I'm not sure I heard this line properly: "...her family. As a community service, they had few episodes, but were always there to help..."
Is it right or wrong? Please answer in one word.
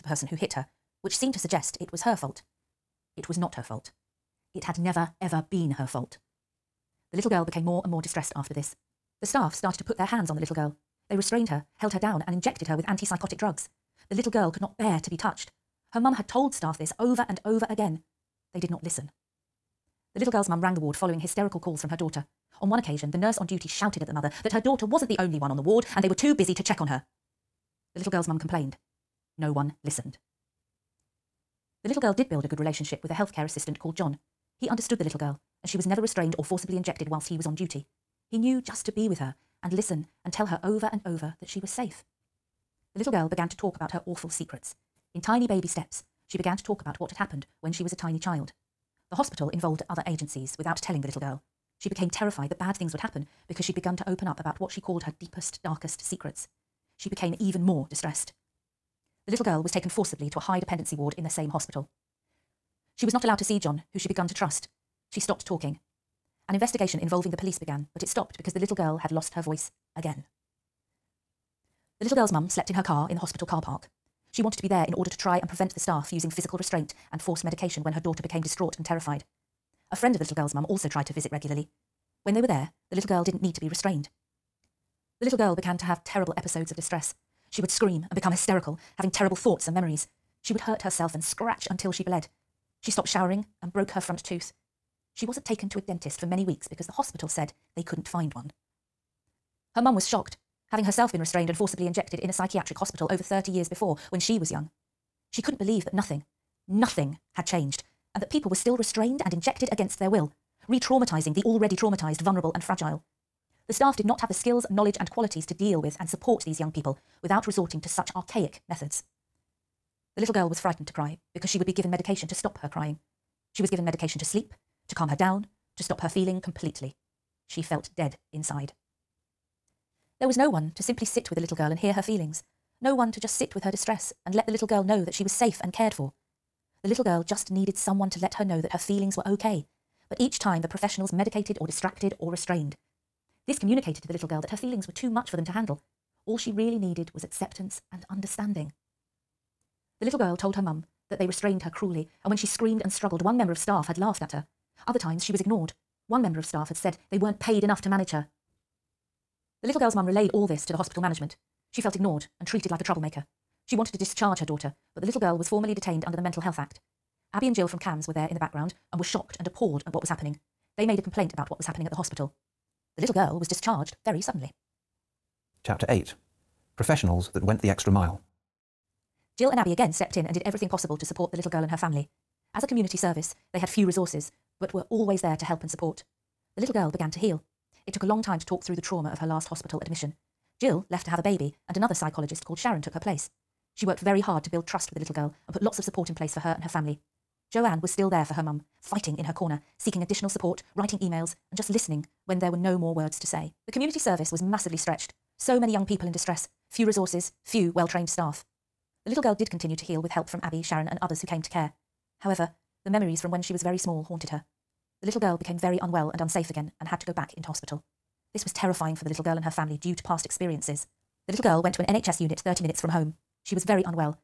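wrong.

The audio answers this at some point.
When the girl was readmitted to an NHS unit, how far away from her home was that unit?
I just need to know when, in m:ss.
3:42.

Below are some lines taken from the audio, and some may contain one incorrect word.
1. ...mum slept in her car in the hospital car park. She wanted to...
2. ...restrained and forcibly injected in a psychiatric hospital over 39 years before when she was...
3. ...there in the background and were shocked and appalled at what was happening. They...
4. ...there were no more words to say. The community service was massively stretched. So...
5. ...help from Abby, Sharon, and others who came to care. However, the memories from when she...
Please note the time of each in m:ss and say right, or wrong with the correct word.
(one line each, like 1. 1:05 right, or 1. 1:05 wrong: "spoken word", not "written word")
1. 1:12 right
2. 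1:41 wrong: "30", not "39"
3. 2:48 right
4. 3:22 right
5. 3:30 right.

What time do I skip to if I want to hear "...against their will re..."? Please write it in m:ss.
1:49.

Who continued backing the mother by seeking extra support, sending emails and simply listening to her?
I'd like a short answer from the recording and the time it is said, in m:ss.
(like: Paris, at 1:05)
Joanne, at 3:17.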